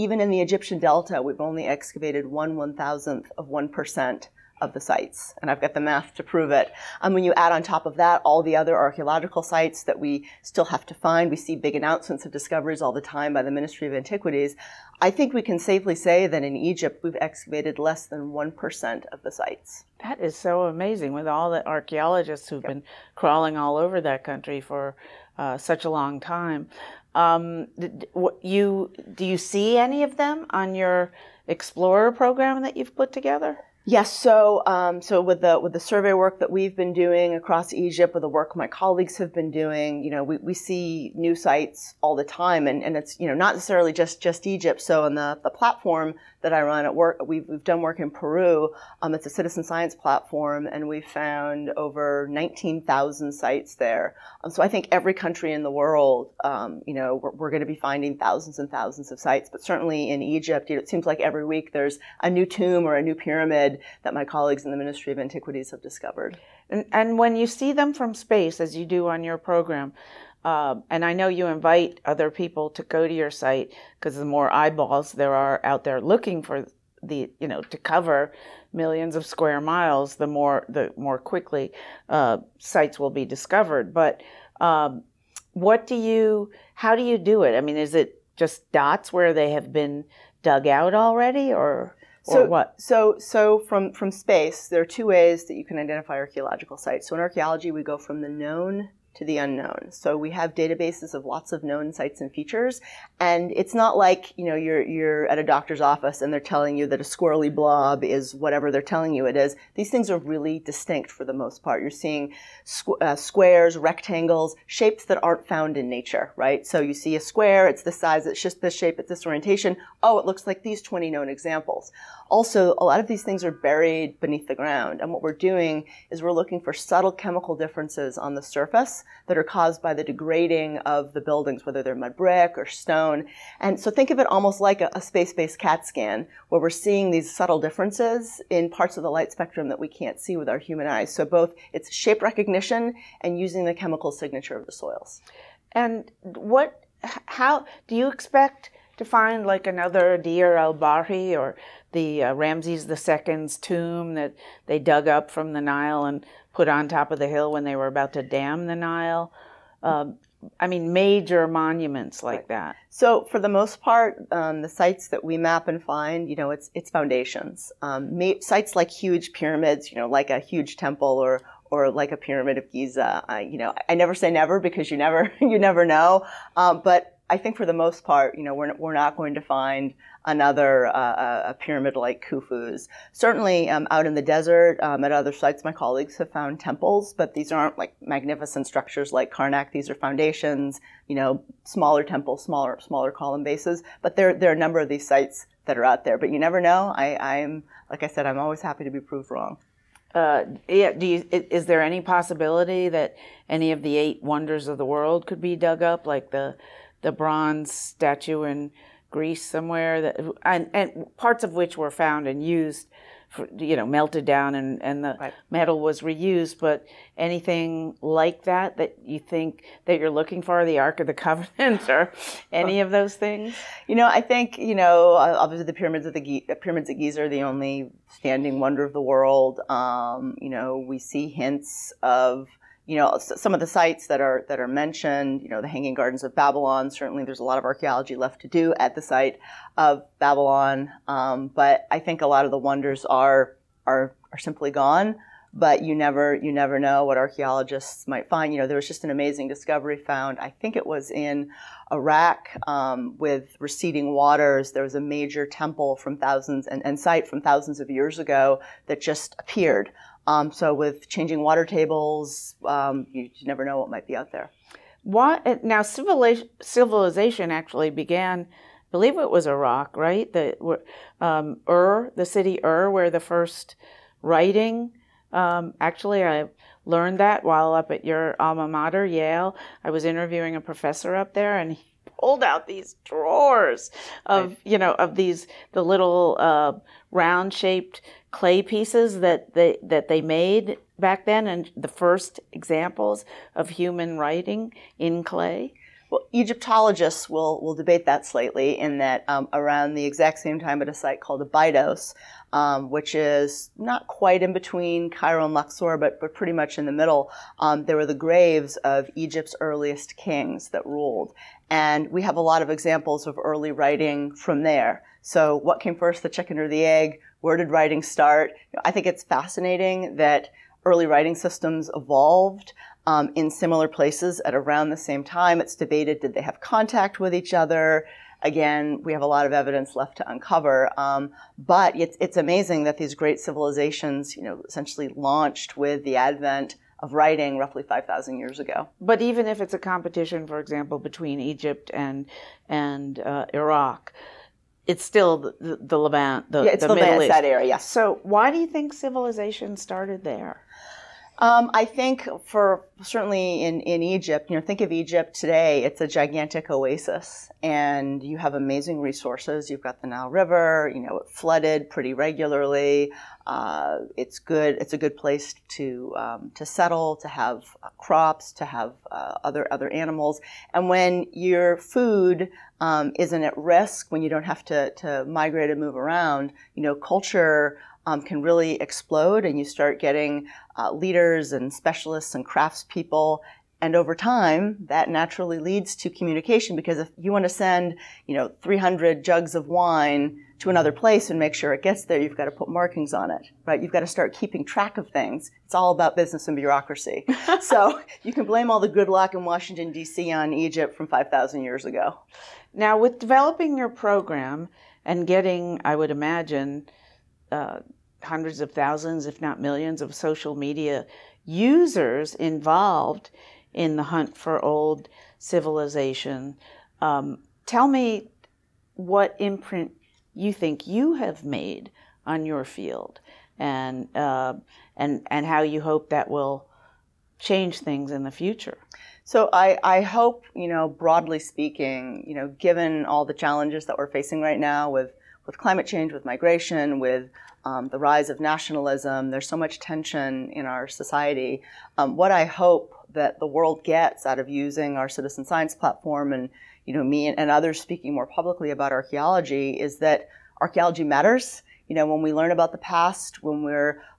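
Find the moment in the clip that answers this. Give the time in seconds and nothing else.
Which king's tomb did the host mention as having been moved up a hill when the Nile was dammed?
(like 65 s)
152 s.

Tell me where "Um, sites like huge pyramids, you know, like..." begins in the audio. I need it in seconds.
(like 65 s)
167 s.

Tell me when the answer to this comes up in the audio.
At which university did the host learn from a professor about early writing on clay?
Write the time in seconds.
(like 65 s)
279 s.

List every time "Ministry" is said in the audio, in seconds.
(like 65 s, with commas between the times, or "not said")
13 s, 64 s.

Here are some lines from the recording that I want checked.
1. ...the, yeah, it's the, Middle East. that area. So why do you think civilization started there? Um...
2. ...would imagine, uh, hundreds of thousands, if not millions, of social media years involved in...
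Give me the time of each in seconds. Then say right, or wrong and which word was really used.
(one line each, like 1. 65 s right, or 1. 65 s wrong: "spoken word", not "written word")
1. 346 s right
2. 405 s wrong: "users", not "years".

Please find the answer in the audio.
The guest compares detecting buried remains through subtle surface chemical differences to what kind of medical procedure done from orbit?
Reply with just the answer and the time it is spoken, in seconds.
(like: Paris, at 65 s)
CAT scan, at 135 s.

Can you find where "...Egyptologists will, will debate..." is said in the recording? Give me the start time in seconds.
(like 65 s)
296 s.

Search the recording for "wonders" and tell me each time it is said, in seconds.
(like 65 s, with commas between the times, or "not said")
204 s, 228 s, 242 s.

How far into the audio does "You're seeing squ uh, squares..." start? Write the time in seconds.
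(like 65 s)
111 s.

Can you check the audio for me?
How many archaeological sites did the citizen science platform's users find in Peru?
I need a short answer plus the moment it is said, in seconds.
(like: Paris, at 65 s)
19,000, at 52 s.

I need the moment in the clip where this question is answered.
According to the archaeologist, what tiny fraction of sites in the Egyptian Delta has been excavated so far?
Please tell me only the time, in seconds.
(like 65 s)
2 s.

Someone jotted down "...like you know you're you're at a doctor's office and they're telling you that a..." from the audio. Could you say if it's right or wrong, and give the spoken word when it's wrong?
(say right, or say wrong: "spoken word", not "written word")
right.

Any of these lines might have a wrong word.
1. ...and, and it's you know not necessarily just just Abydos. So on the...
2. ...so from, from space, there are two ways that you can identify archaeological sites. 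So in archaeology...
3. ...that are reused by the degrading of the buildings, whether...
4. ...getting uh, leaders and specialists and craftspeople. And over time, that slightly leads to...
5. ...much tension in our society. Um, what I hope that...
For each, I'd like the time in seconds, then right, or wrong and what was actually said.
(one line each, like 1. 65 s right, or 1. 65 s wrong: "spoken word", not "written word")
1. 42 s wrong: "Egypt", not "Abydos"
2. 93 s right
3. 129 s wrong: "caused", not "reused"
4. 379 s wrong: "naturally", not "slightly"
5. 439 s right.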